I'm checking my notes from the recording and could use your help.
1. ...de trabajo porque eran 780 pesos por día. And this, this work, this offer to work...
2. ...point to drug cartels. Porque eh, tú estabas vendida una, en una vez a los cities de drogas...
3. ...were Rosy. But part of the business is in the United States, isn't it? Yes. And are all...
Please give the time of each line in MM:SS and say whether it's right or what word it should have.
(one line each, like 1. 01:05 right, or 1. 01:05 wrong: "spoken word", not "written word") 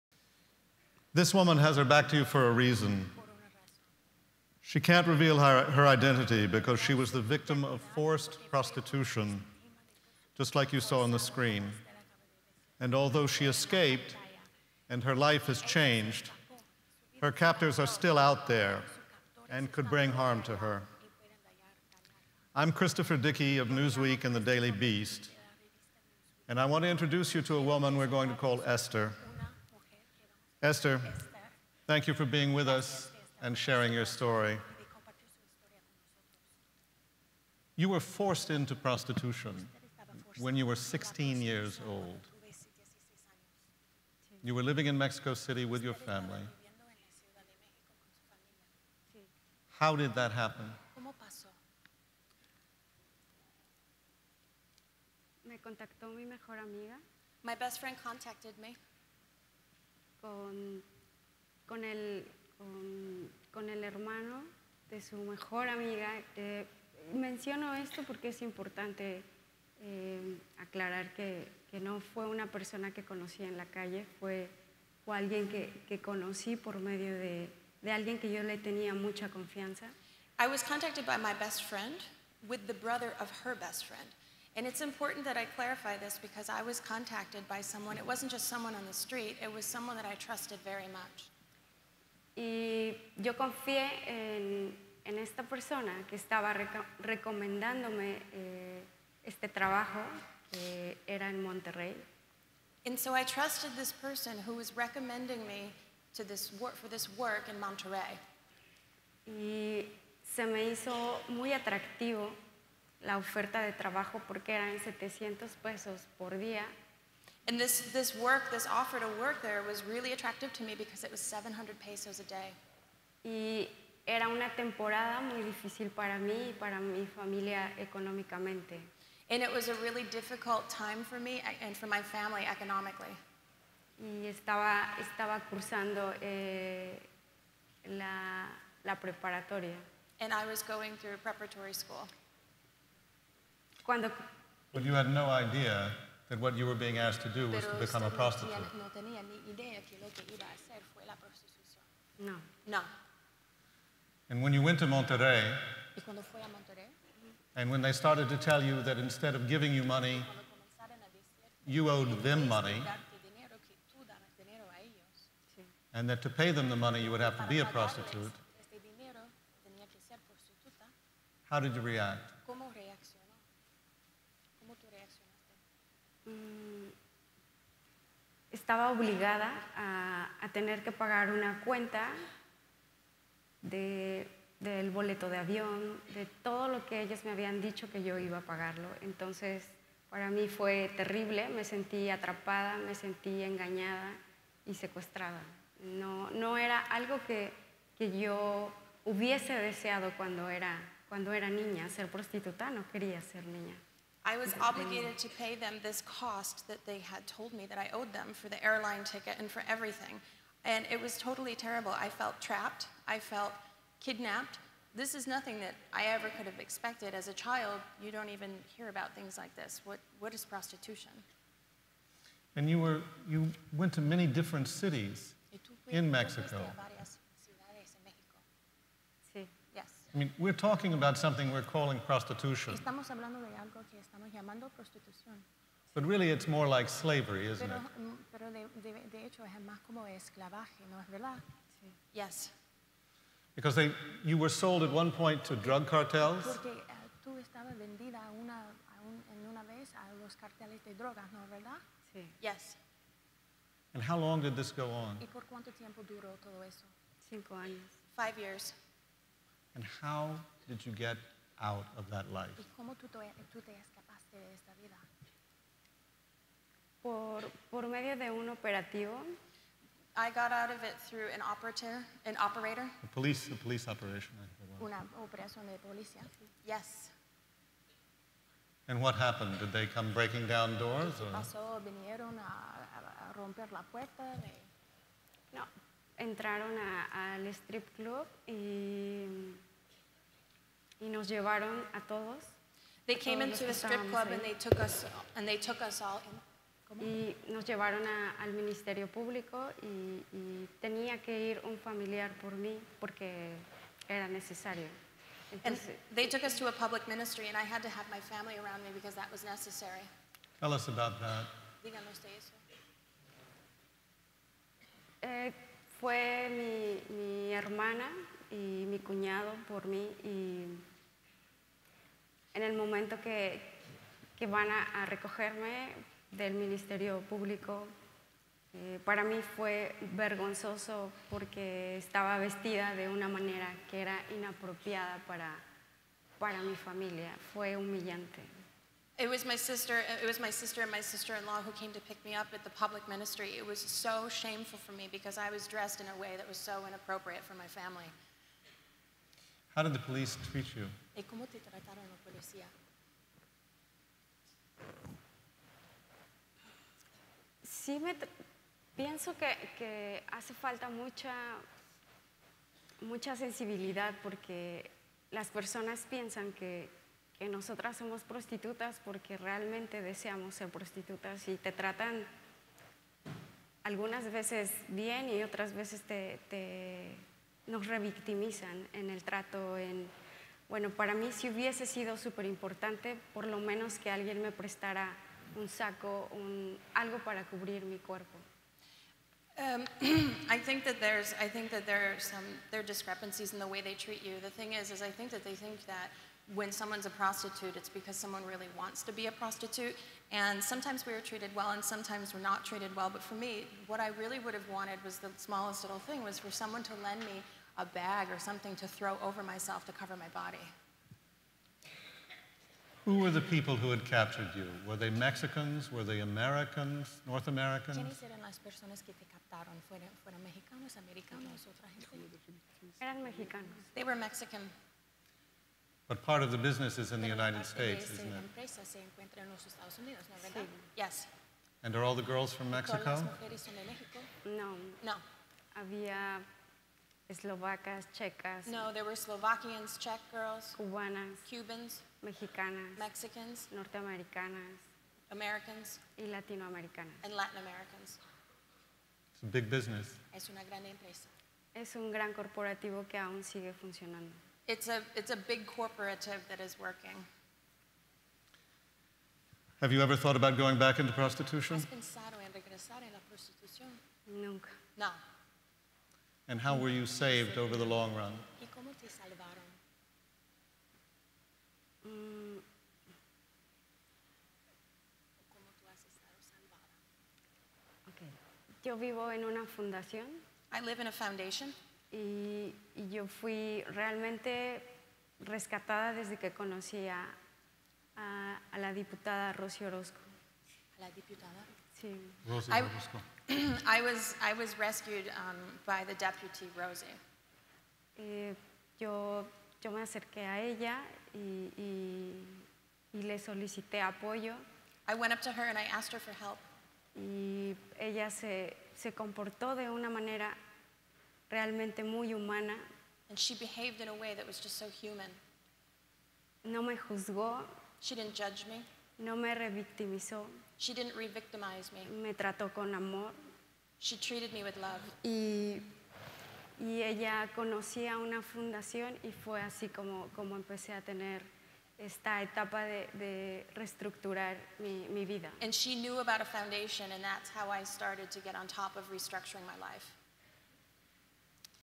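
1. 01:53 wrong: "700", not "780"
2. 04:05 wrong: "carteles", not "cities"
3. 07:04 wrong: "Mexican", not "Rosy".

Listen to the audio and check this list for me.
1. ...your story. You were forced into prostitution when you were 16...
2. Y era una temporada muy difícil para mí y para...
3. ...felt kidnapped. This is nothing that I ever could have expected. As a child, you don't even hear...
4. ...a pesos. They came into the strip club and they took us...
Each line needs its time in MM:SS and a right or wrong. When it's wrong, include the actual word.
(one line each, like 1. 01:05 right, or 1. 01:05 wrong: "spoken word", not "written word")
1. 00:33 right
2. 02:03 right
3. 03:33 right
4. 04:51 wrong: "todos", not "pesos".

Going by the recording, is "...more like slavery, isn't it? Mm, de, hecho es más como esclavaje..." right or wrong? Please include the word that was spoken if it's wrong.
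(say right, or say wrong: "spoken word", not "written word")
right.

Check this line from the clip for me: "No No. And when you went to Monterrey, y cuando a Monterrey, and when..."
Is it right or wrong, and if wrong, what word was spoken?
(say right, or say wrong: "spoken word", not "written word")
right.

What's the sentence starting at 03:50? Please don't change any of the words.
I mean, we're talking about something we're calling prostitution.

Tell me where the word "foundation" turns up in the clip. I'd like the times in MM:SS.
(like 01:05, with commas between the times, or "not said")
08:01, 08:56.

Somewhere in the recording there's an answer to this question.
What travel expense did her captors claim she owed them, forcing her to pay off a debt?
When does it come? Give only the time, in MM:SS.
03:28.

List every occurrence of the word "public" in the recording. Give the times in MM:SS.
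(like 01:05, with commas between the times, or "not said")
05:06, 05:42.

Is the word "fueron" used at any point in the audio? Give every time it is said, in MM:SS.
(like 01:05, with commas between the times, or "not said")
06:59.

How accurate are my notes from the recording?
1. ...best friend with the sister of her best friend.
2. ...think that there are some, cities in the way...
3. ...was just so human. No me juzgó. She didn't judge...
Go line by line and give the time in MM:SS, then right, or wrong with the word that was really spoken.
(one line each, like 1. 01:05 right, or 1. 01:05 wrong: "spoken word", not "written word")
1. 01:21 wrong: "brother", not "sister"
2. 06:30 wrong: "discrepancies", not "cities"
3. 08:34 right.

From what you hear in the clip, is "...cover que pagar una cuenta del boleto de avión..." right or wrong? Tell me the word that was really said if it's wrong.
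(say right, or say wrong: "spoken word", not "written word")
wrong: "tener", not "cover".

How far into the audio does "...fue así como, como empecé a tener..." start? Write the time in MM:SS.
08:49.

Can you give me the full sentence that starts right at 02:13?
Y estaba, estaba cursando eh, la, la preparatoria.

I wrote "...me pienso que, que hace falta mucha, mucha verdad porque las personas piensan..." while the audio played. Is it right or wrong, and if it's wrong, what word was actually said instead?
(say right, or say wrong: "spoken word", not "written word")
wrong: "sensibilidad", not "verdad".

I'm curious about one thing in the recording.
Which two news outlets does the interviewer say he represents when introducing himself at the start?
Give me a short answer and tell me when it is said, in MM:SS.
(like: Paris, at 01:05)
Newsweek and the Daily Beast, at 00:23.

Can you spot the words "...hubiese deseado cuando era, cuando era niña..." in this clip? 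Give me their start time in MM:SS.
03:19.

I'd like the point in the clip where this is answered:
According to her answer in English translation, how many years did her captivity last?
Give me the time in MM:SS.
04:18.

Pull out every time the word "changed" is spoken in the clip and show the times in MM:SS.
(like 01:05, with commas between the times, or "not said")
00:15.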